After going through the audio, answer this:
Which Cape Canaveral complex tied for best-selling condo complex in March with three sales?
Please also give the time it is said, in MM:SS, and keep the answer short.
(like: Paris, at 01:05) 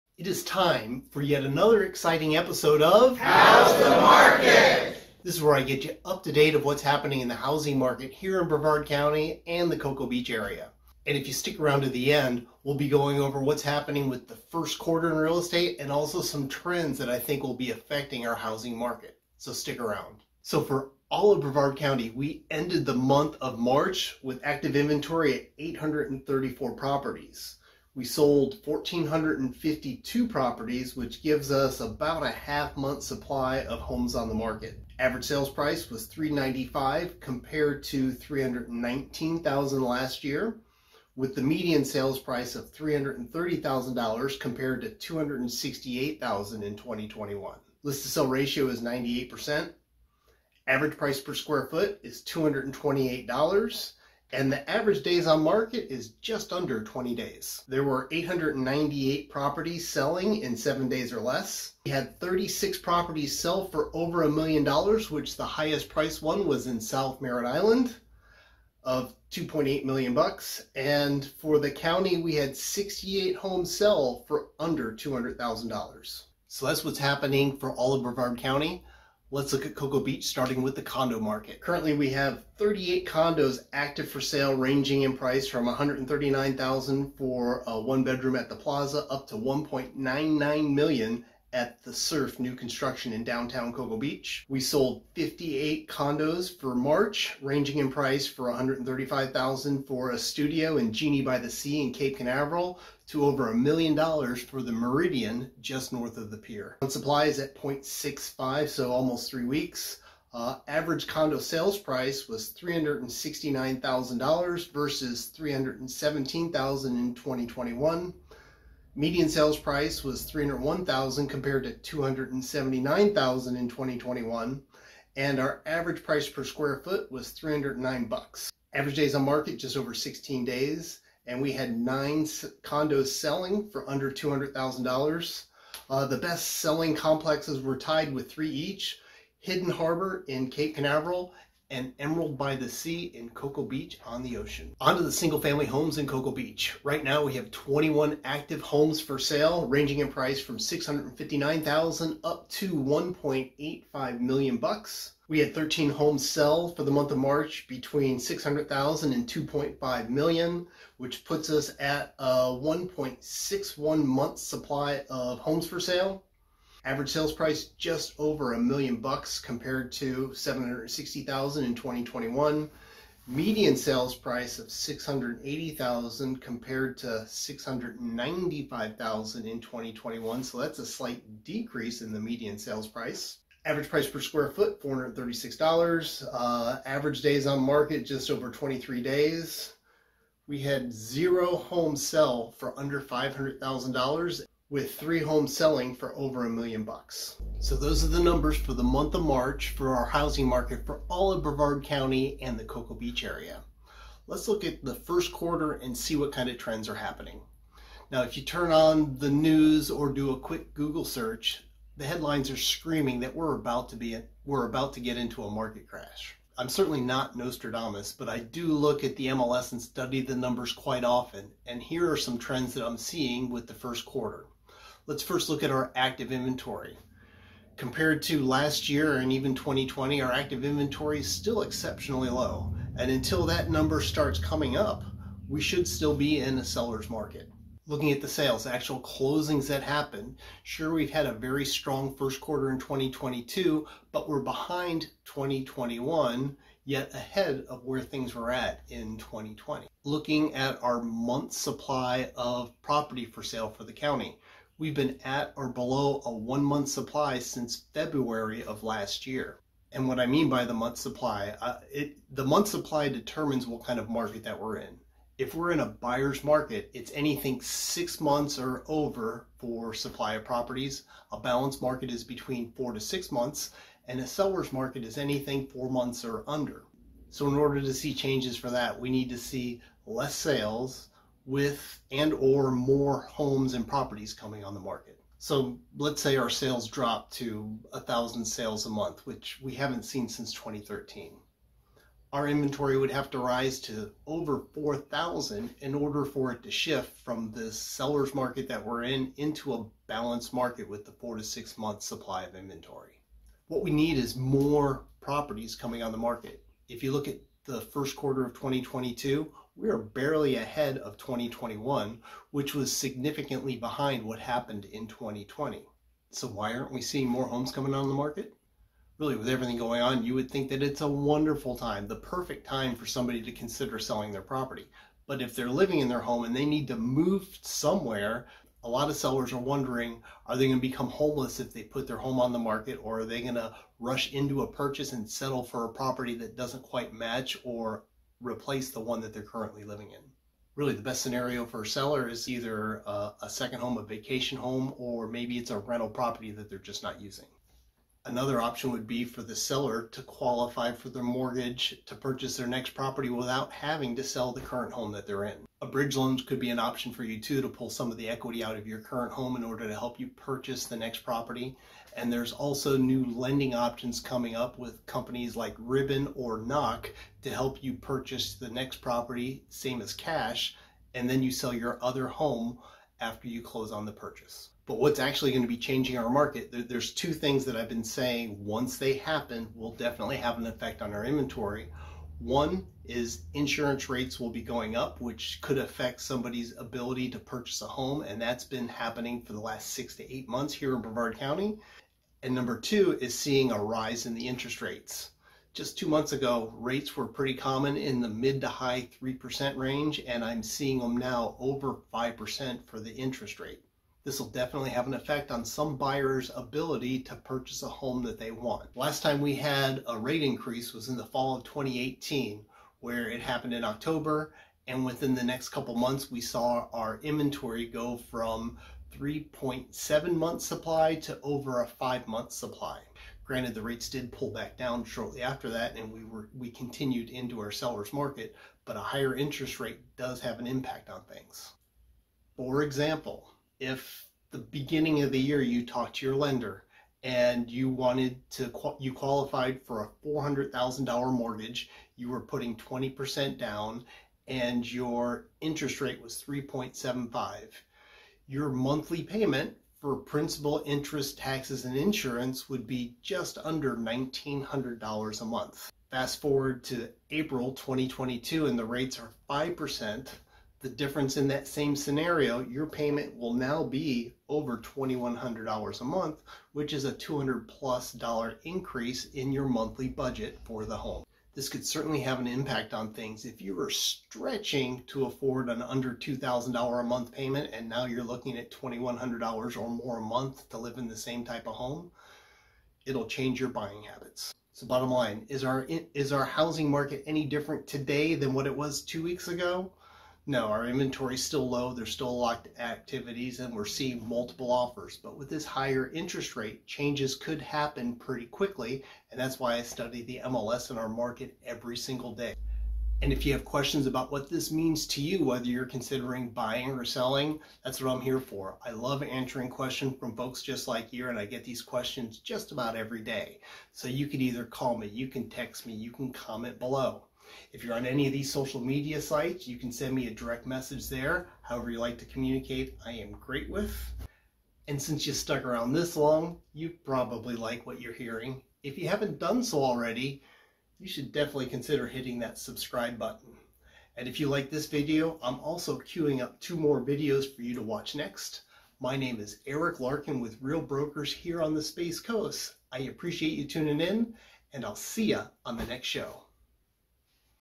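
Hidden Harbor, at 02:19.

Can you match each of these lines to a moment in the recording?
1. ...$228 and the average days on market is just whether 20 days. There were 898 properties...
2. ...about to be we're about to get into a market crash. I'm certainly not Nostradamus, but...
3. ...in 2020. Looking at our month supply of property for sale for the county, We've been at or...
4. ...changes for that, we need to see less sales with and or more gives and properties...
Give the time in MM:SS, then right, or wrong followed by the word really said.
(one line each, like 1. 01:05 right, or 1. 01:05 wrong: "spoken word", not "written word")
1. 00:52 wrong: "under", not "whether"
2. 03:33 right
3. 04:08 right
4. 04:38 wrong: "homes", not "gives".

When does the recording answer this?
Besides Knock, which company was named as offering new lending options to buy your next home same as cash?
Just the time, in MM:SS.
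06:05.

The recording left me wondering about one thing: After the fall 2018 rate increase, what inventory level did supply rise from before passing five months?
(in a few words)
3.7 month supply.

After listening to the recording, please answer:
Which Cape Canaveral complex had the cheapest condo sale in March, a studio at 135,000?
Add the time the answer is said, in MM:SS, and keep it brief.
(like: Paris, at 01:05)
Genie by the Sea, at 01:40.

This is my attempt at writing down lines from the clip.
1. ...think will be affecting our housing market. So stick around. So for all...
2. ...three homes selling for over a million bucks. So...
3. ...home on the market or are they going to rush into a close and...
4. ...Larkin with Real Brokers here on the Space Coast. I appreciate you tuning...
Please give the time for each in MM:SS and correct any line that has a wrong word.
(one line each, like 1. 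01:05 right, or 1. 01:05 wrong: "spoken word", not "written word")
1. 00:17 right
2. 03:14 right
3. 05:32 wrong: "purchase", not "close"
4. 08:59 right.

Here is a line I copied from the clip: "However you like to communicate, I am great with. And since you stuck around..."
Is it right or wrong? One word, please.
right.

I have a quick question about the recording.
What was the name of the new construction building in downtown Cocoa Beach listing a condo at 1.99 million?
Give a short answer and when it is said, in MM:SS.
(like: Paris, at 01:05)
the Surf, at 01:31.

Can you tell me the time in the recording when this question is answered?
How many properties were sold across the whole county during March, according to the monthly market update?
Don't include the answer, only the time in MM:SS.
00:28.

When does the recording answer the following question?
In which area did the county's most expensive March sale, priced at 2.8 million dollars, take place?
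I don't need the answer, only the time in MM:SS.
01:06.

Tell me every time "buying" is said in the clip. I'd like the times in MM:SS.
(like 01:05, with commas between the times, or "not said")
08:03, 08:26.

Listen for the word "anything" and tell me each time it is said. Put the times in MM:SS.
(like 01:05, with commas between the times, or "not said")
04:27, 04:35.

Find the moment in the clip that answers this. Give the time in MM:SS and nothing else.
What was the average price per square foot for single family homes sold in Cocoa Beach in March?
03:04.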